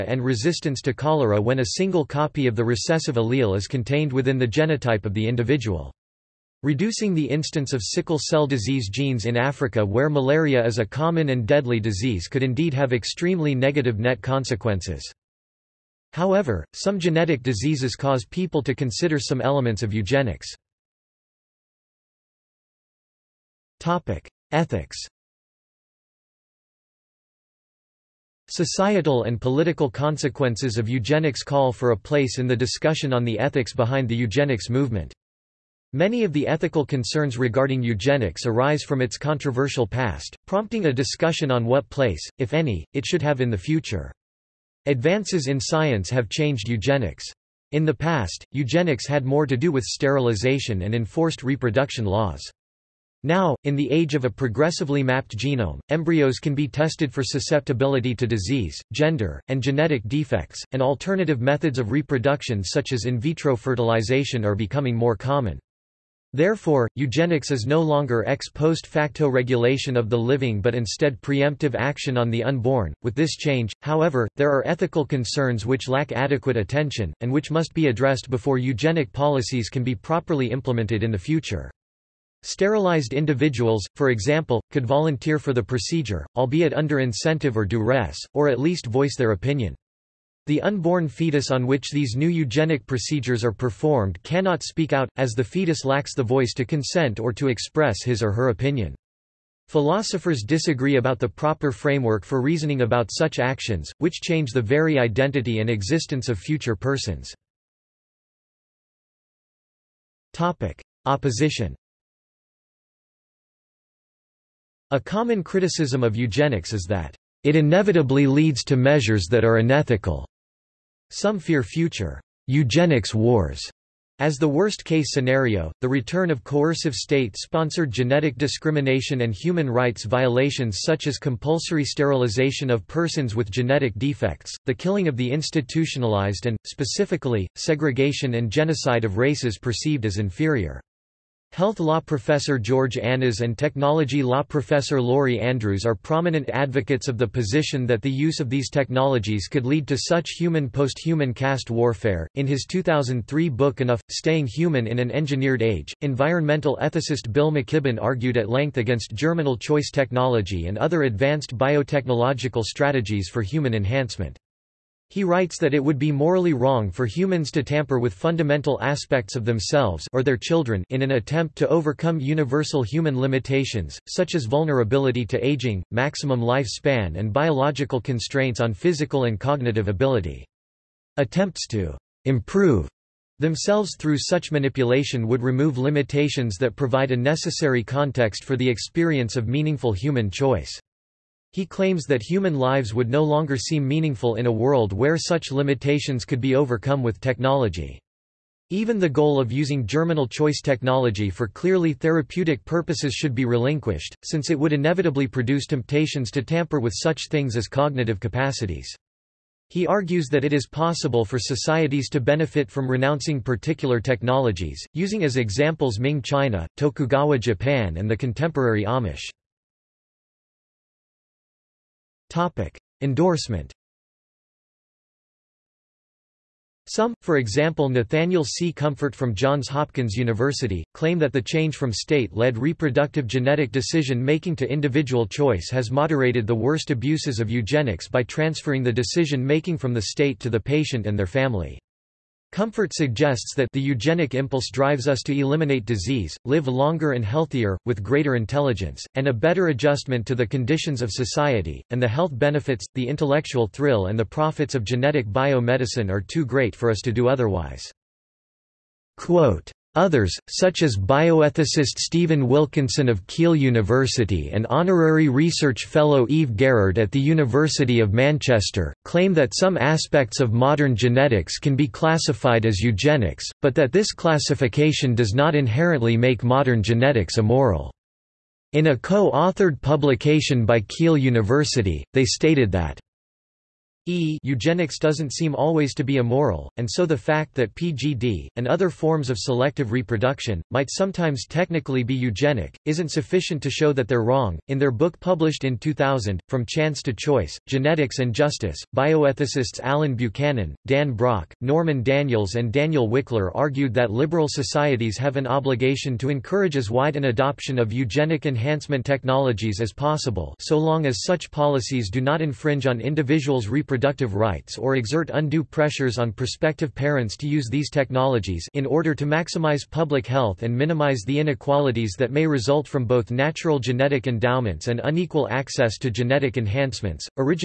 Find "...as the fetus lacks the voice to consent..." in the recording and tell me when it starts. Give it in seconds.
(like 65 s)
95 s.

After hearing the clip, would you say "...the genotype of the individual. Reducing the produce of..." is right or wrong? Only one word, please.
wrong.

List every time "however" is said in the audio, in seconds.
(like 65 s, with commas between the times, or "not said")
16 s, 73 s.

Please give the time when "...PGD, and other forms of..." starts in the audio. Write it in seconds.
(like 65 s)
287 s.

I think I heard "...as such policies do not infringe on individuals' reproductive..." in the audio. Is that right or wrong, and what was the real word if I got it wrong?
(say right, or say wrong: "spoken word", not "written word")
right.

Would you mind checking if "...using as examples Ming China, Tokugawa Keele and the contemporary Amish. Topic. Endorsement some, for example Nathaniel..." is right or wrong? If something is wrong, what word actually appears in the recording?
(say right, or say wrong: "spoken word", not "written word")
wrong: "Japan", not "Keele".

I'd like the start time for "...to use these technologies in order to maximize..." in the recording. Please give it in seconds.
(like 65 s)
317 s.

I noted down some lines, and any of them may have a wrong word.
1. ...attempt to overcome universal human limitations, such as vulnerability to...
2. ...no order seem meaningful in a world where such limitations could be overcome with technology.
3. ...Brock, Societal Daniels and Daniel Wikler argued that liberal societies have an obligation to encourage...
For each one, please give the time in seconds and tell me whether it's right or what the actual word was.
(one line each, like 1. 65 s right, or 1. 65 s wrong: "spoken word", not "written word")
1. 171 s right
2. 193 s wrong: "longer", not "order"
3. 301 s wrong: "Norman", not "Societal".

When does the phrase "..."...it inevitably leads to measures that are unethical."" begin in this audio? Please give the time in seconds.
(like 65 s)
117 s.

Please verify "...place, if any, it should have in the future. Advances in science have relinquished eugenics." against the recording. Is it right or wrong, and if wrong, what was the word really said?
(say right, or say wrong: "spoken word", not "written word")
wrong: "changed", not "relinquished".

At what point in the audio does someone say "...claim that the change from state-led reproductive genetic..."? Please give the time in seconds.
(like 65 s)
230 s.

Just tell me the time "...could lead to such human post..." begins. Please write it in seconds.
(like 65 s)
149 s.